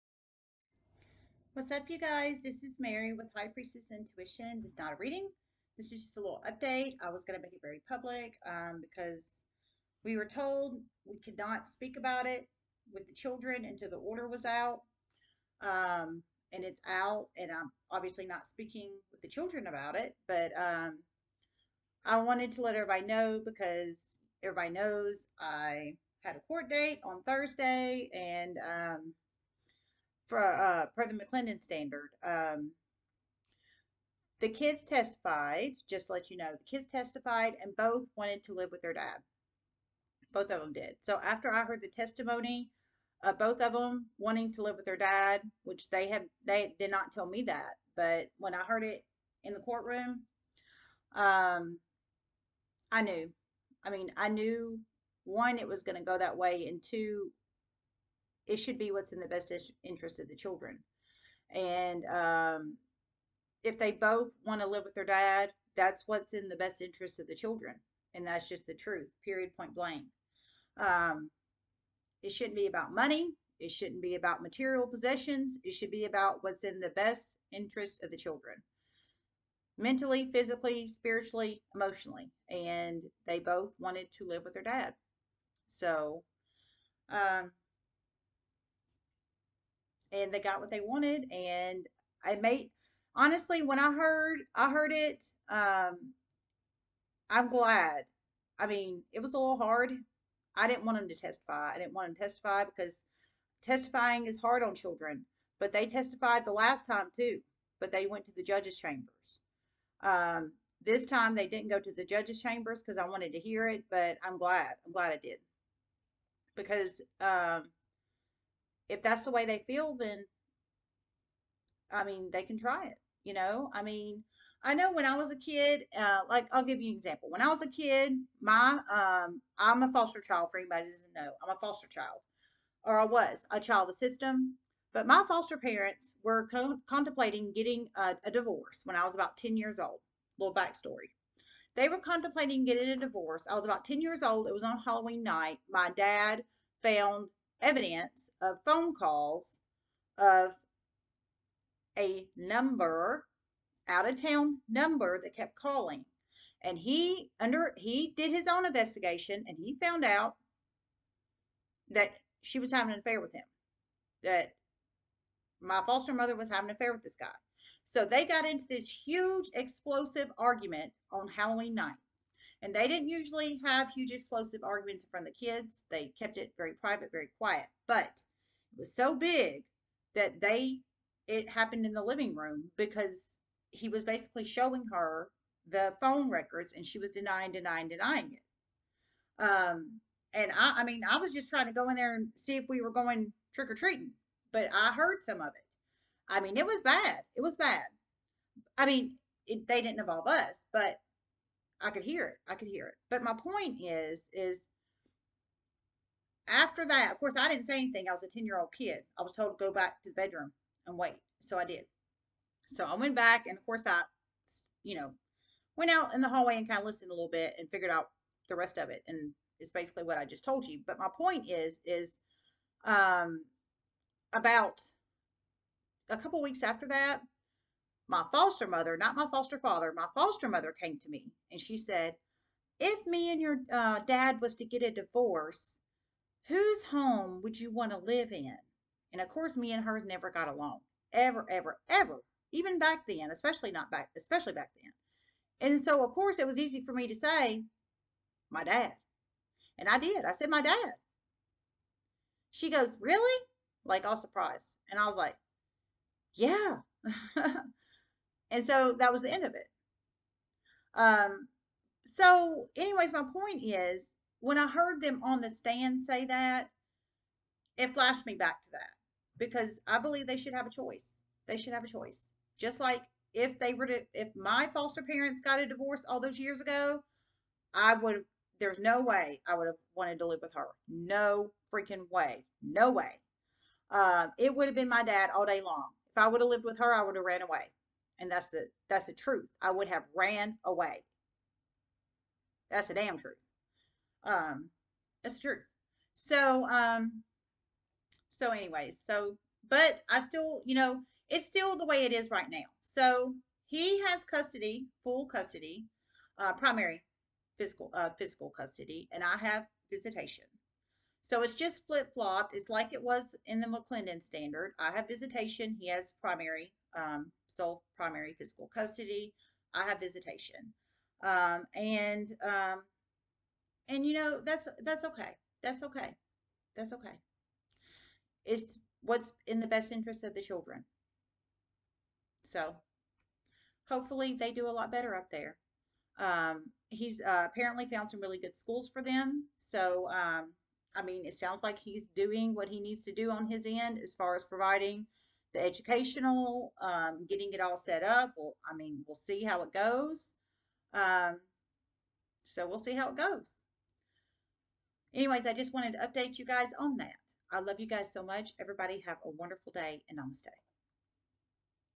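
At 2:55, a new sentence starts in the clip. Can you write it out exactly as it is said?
They kept it very private, very quiet.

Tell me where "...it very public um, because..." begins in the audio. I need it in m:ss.
0:07.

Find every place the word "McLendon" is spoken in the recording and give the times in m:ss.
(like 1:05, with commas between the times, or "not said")
0:31, 5:13.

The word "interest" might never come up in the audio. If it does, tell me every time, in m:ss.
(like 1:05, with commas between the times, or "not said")
0:59, 1:06, 1:17, 5:29.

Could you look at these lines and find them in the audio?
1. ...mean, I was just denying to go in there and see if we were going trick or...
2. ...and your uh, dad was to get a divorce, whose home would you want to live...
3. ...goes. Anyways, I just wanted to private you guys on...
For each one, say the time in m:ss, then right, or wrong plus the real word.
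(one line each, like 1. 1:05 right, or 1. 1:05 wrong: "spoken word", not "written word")
1. 3:10 wrong: "trying", not "denying"
2. 3:53 right
3. 5:53 wrong: "update", not "private".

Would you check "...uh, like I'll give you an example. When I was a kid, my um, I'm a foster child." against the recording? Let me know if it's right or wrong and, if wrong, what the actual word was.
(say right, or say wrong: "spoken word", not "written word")
right.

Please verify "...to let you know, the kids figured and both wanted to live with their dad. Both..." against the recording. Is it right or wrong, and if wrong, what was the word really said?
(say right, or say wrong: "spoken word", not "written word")
wrong: "testified", not "figured".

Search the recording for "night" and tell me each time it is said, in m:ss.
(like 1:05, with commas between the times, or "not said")
2:25, 2:51.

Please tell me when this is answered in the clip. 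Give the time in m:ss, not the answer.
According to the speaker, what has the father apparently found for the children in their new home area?
5:38.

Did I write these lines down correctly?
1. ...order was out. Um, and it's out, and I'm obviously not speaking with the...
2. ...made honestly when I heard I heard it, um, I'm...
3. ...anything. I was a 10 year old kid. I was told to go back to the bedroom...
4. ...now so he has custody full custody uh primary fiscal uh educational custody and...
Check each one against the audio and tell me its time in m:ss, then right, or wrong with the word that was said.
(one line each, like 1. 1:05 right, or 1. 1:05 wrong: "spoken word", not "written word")
1. 0:13 right
2. 1:32 right
3. 3:27 right
4. 5:02 wrong: "physical", not "educational".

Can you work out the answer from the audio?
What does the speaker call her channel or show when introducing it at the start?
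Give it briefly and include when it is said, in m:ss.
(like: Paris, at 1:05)
High Priestess Intuition, at 0:03.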